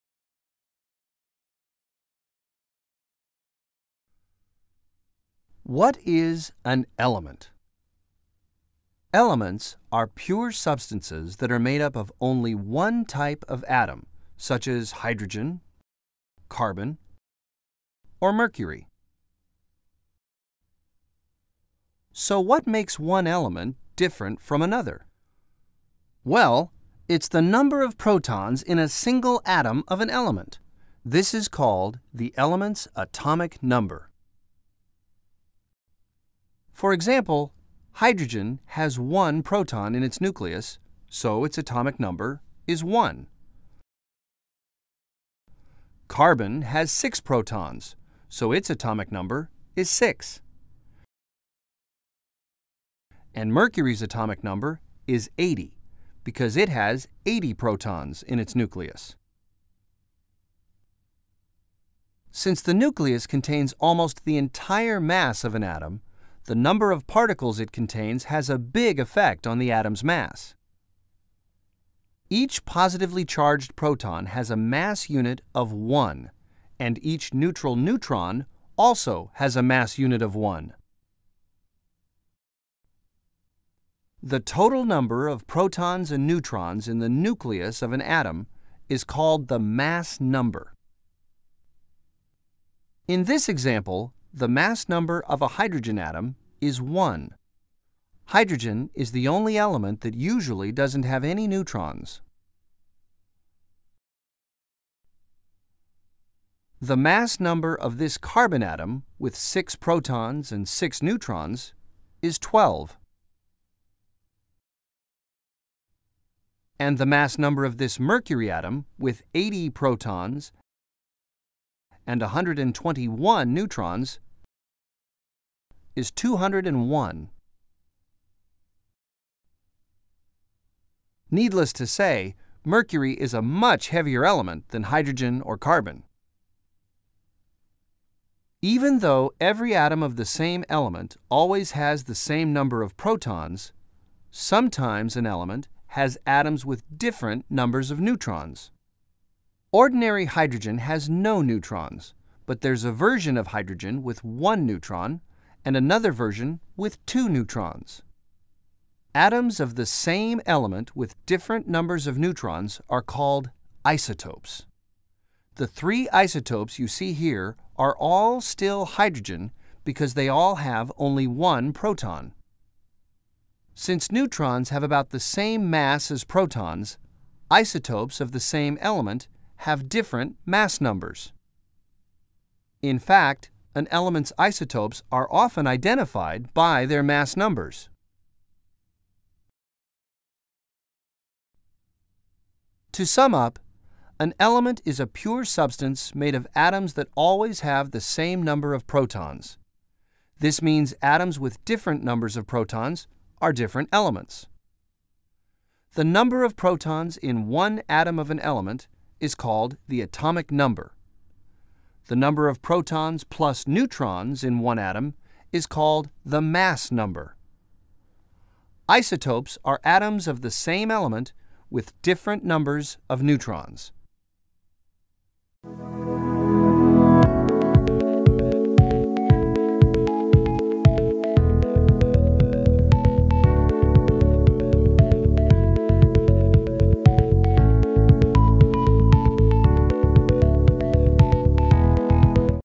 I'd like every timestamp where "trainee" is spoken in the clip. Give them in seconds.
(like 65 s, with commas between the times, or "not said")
not said.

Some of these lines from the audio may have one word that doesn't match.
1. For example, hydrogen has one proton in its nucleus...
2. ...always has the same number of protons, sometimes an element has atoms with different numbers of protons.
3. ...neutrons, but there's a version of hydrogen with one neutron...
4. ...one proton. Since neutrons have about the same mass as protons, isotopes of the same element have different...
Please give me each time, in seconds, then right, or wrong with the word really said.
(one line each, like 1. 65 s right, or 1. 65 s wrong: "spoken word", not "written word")
1. 36 s right
2. 141 s wrong: "neutrons", not "protons"
3. 151 s right
4. 171 s right.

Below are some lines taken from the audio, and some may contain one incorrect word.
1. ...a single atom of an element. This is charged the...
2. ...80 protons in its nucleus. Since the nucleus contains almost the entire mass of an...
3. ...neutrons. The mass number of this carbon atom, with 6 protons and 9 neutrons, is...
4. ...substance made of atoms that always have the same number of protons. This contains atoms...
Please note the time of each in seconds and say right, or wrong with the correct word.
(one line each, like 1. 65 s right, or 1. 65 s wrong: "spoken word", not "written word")
1. 28 s wrong: "called", not "charged"
2. 57 s right
3. 101 s wrong: "6", not "9"
4. 195 s wrong: "means", not "contains".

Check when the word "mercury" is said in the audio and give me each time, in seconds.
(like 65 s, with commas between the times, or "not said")
18 s, 53 s, 117 s, 132 s.